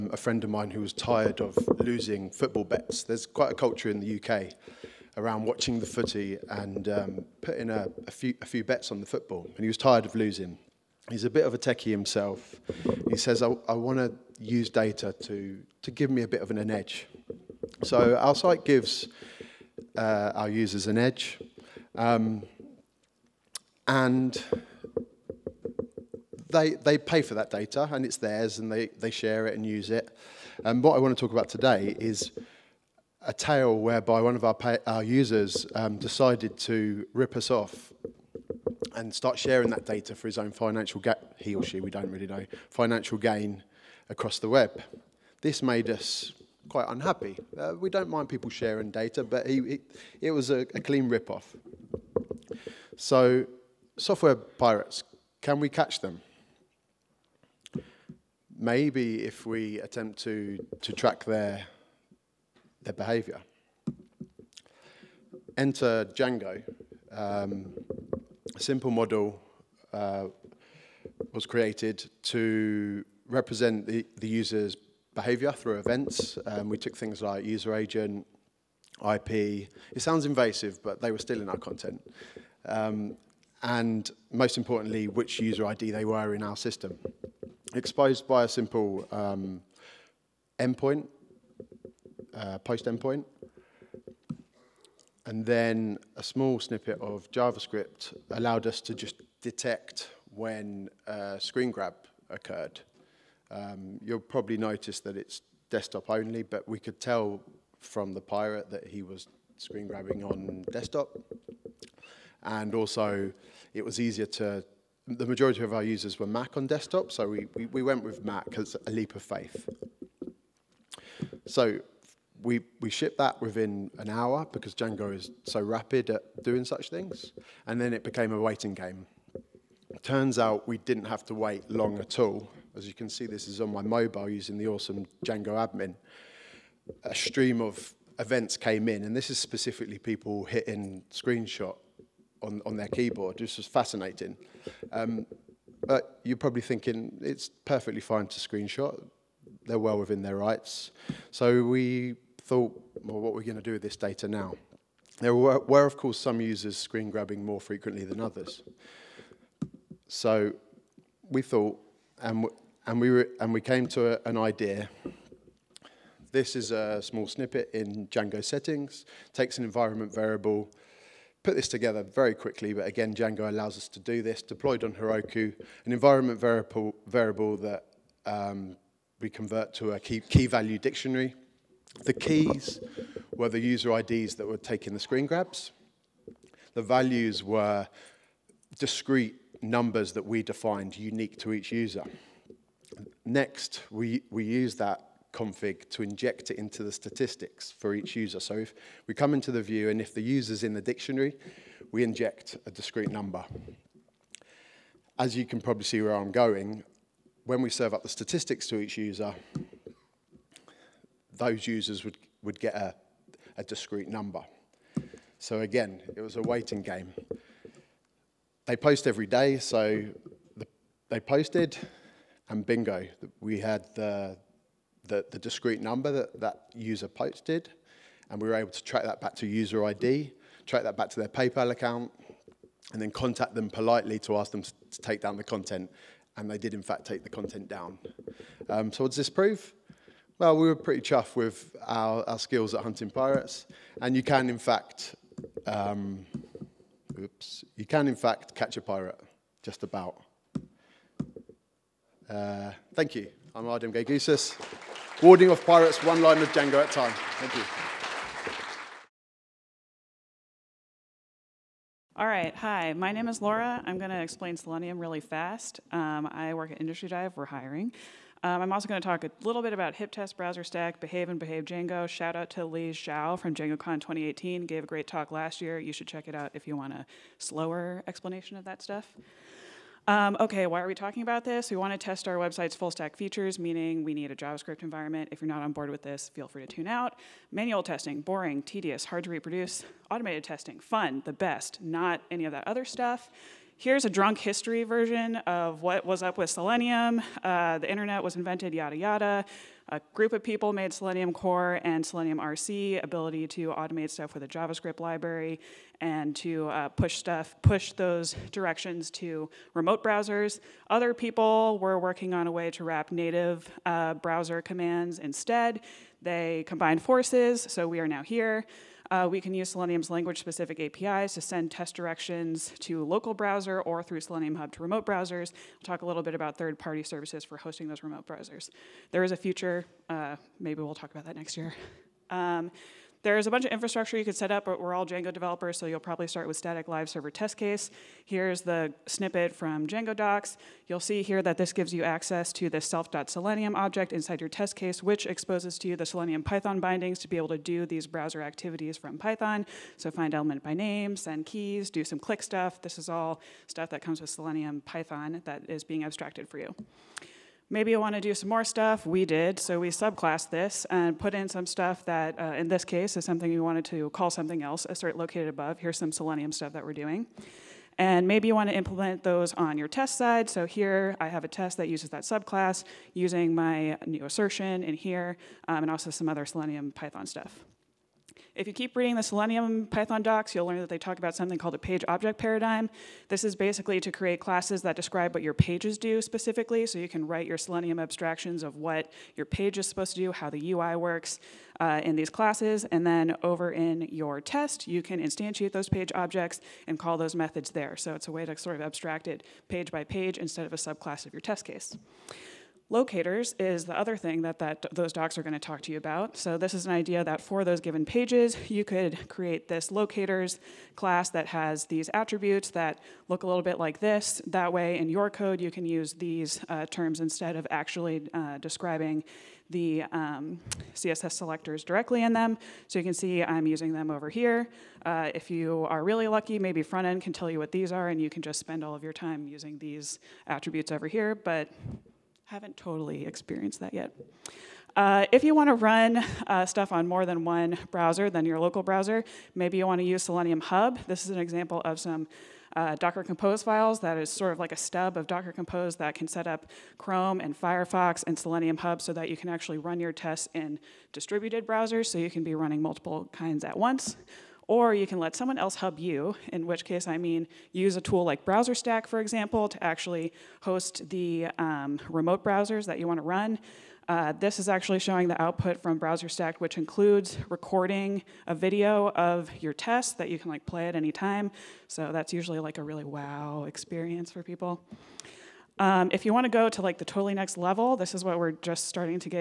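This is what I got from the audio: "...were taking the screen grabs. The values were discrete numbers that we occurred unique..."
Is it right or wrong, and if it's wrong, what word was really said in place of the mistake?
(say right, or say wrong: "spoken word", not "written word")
wrong: "defined", not "occurred".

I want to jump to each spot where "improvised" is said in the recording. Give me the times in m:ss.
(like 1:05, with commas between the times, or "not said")
not said.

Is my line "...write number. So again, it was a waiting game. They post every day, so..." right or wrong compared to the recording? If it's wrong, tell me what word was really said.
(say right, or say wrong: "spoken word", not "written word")
wrong: "discrete", not "write".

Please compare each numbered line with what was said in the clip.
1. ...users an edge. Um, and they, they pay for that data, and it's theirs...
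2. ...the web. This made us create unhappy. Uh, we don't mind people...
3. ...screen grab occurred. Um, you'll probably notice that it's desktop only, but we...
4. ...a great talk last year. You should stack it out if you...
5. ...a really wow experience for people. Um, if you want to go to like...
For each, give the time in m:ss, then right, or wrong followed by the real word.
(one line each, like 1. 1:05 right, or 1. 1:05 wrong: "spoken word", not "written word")
1. 0:20 right
2. 0:44 wrong: "quite", not "create"
3. 1:41 right
4. 4:34 wrong: "check", not "stack"
5. 7:52 right.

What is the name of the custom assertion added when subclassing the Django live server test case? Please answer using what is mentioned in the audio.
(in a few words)
assert located above.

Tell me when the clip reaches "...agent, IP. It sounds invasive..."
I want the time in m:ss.
1:17.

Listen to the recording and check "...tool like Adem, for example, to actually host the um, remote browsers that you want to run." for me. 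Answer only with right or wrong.
wrong.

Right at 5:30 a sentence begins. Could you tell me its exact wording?
Uh, maybe we'll talk about that next year.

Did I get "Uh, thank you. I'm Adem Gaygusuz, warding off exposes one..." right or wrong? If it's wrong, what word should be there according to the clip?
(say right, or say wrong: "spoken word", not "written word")
wrong: "pirates", not "exposes".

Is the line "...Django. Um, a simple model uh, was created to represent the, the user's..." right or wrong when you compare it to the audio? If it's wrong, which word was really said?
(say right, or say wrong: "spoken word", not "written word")
right.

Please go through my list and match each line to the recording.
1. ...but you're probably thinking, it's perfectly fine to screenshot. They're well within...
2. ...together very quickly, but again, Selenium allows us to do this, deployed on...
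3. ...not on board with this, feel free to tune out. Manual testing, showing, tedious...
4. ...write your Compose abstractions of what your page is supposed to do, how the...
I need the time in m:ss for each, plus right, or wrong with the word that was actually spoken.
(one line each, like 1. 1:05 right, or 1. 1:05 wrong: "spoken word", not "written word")
1. 2:25 right
2. 2:51 wrong: "Django", not "Selenium"
3. 4:45 wrong: "boring", not "showing"
4. 6:27 wrong: "Selenium", not "Compose".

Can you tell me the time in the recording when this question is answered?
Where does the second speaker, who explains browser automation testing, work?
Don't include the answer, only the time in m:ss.
4:26.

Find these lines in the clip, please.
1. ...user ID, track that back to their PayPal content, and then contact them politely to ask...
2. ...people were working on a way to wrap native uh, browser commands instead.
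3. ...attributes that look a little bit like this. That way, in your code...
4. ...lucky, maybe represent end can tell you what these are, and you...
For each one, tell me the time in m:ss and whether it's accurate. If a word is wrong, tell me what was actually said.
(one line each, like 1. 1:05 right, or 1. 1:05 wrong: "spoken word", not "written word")
1. 3:49 wrong: "account", not "content"
2. 5:11 right
3. 6:52 right
4. 7:06 wrong: "front", not "represent".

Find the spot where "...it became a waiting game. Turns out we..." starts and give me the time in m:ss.
2:07.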